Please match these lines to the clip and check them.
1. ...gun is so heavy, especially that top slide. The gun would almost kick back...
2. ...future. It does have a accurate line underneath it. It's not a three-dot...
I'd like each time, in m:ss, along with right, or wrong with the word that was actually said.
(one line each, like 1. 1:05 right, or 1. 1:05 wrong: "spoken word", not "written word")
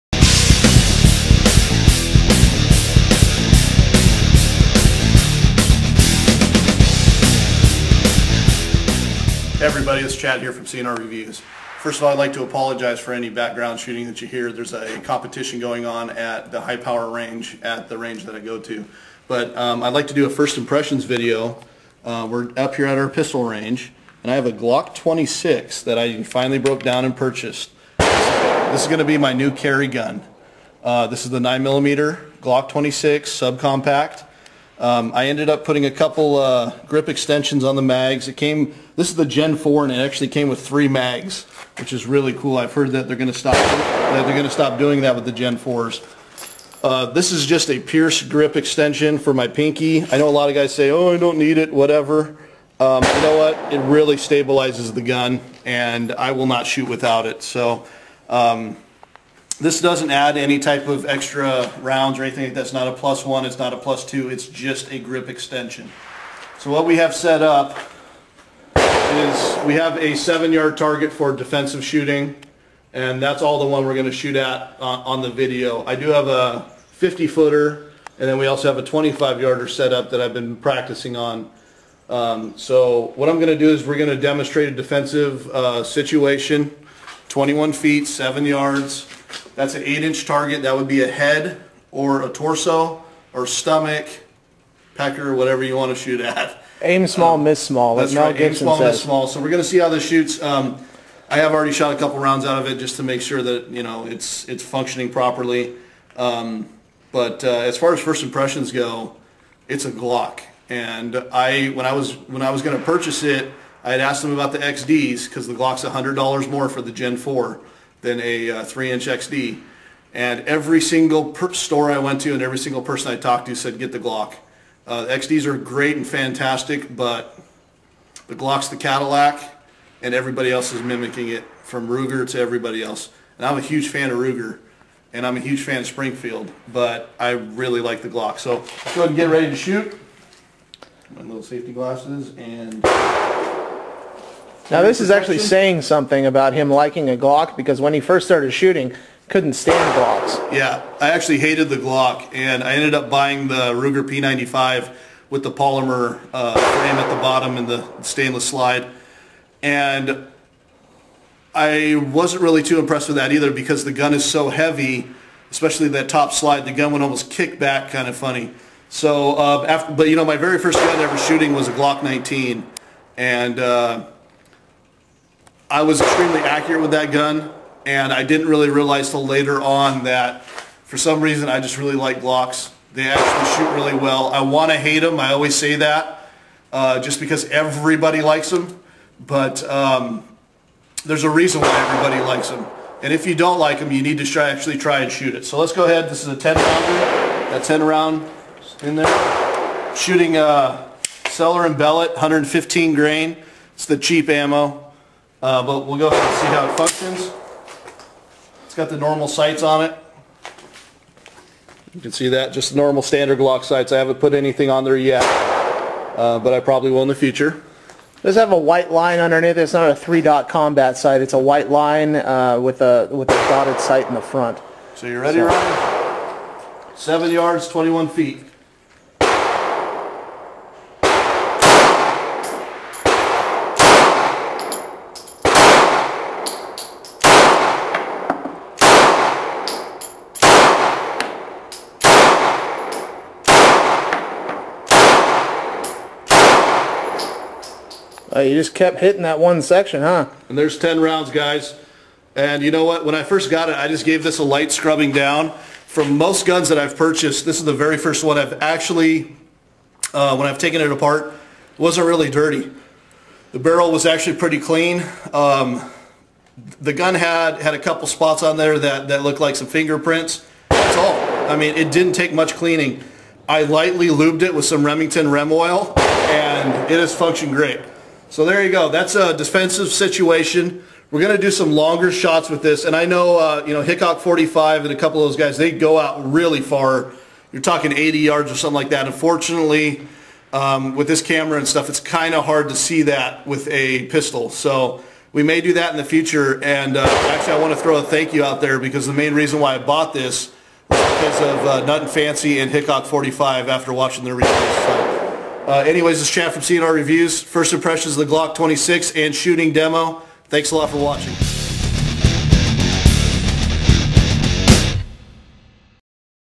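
1. 2:43 right
2. 3:37 wrong: "white", not "accurate".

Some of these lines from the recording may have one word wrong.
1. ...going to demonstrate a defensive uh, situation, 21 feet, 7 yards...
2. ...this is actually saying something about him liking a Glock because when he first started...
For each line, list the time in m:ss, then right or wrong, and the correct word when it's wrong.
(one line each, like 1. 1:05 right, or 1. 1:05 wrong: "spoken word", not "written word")
1. 1:23 right
2. 2:24 right.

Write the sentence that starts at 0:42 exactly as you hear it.
I've heard that they're going to stop, that they're going to stop doing that with the Gen 4s.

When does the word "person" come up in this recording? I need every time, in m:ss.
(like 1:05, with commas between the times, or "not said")
2:02.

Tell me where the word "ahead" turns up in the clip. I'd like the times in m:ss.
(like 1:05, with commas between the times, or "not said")
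2:19, 3:15, 3:26.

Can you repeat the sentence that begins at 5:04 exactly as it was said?
So, uh, anyways, this is Chad from CNR Reviews.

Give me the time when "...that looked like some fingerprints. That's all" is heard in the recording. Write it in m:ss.
4:29.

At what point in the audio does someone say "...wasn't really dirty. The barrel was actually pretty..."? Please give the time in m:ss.
4:21.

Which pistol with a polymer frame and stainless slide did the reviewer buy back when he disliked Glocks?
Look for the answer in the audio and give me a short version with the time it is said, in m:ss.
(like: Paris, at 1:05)
Ruger P95, at 2:33.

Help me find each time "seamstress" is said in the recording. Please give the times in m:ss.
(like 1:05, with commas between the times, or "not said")
not said.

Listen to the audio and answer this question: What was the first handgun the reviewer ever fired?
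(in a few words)
Glock 19.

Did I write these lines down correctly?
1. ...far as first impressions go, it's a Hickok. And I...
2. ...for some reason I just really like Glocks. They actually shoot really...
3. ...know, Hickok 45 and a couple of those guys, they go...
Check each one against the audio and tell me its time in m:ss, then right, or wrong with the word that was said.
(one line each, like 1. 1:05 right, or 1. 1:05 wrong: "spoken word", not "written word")
1. 1:47 wrong: "Glock", not "Hickok"
2. 3:00 right
3. 4:43 right.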